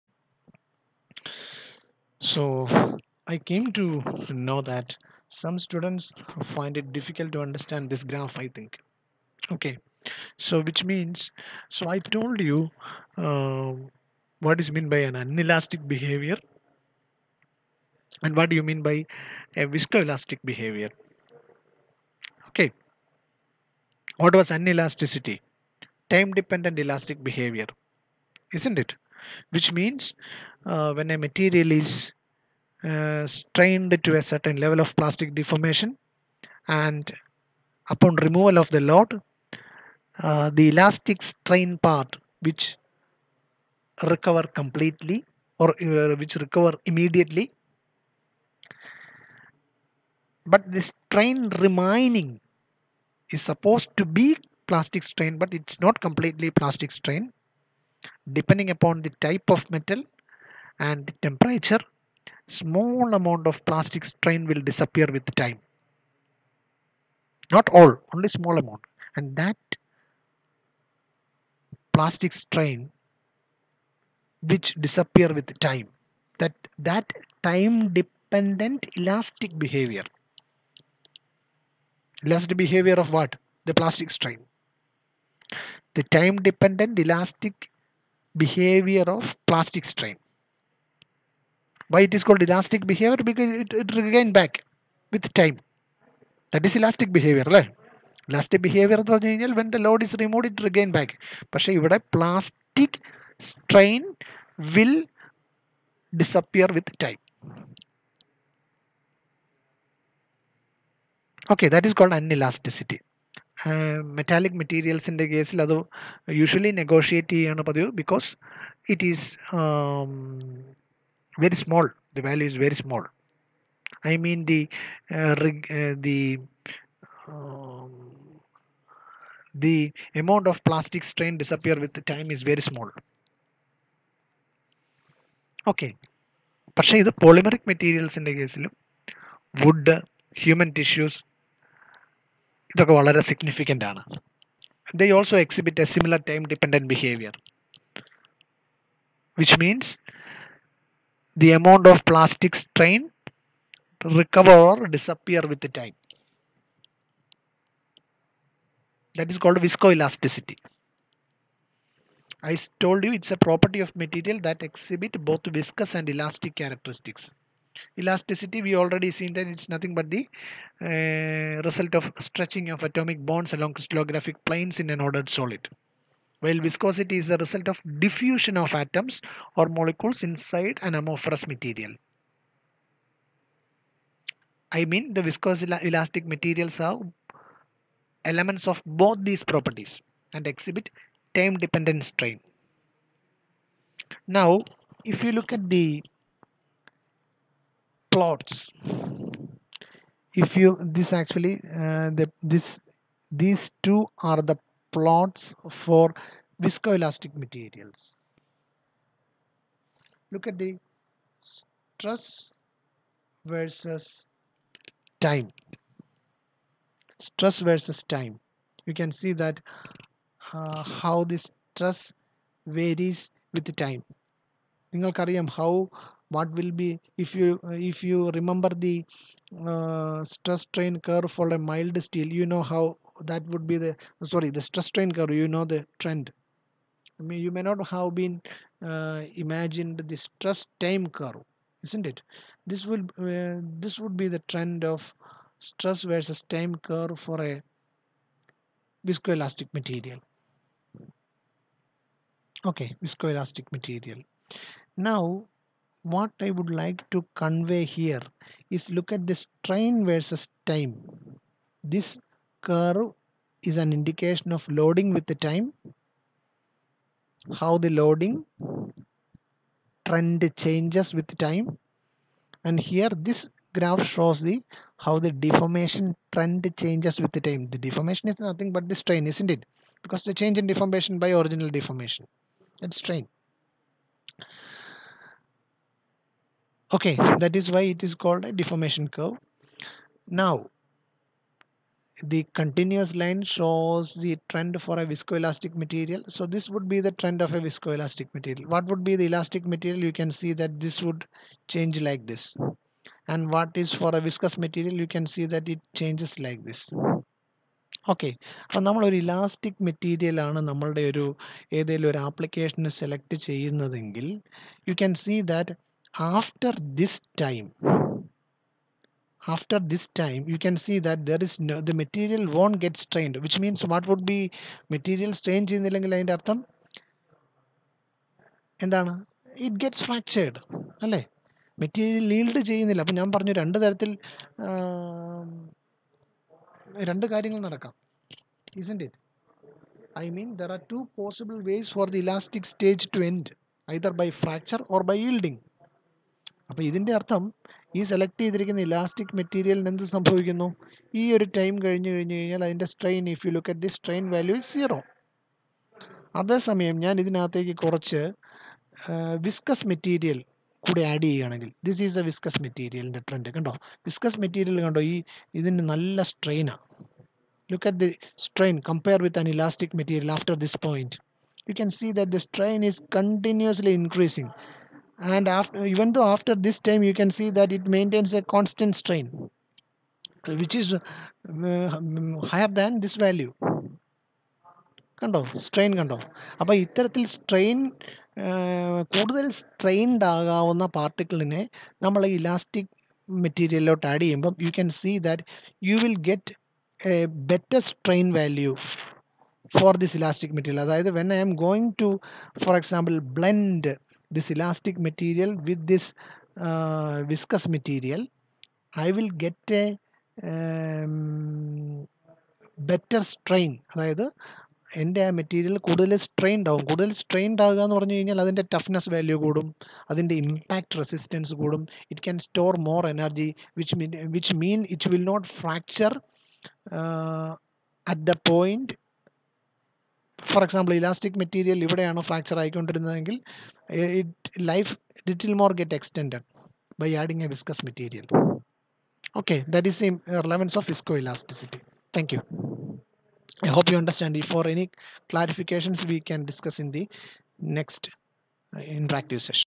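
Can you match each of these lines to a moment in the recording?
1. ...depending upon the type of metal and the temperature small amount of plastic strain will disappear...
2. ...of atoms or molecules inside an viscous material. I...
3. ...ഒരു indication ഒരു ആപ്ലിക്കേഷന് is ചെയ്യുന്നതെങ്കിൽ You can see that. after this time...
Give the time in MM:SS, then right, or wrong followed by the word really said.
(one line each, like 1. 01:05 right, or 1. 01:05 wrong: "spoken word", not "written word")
1. 00:58 right
2. 02:58 wrong: "amorphous", not "viscous"
3. 05:11 wrong: "application", not "indication".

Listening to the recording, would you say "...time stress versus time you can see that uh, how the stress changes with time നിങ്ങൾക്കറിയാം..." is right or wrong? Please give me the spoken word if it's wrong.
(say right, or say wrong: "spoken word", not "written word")
wrong: "varies", not "changes".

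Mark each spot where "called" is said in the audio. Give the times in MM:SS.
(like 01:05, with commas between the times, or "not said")
01:32, 01:51, 02:39, 04:48.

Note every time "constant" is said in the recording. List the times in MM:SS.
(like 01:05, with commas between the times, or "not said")
06:18.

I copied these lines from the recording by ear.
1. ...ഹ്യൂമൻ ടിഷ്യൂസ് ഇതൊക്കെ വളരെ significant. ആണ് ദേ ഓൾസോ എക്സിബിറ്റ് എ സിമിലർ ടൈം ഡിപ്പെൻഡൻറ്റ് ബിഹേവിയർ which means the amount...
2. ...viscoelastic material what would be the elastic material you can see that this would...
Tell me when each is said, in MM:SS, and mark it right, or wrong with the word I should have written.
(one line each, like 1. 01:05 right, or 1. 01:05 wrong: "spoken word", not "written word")
1. 02:20 right
2. 04:57 right.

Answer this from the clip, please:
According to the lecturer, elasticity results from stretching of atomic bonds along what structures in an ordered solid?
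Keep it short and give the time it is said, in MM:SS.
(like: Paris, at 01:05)
Crystallographic planes, at 02:53.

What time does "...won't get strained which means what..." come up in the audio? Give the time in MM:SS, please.
05:22.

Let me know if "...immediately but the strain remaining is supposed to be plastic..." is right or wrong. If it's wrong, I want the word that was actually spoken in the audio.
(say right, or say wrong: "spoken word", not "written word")
right.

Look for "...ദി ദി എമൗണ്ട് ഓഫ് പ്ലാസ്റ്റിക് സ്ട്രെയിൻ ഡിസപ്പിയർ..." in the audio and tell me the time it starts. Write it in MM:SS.
02:06.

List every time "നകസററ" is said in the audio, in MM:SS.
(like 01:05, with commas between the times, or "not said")
07:27.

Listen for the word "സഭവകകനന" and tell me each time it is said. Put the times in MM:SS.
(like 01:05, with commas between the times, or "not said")
05:50.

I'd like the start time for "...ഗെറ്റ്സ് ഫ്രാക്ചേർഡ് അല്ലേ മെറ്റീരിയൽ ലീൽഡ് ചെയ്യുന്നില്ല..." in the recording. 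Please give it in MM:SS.
05:29.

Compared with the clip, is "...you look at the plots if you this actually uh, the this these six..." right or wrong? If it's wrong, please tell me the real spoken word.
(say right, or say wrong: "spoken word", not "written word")
wrong: "two", not "six".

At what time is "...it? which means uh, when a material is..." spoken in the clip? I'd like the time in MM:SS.
00:28.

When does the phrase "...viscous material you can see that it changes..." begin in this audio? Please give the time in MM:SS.
05:04.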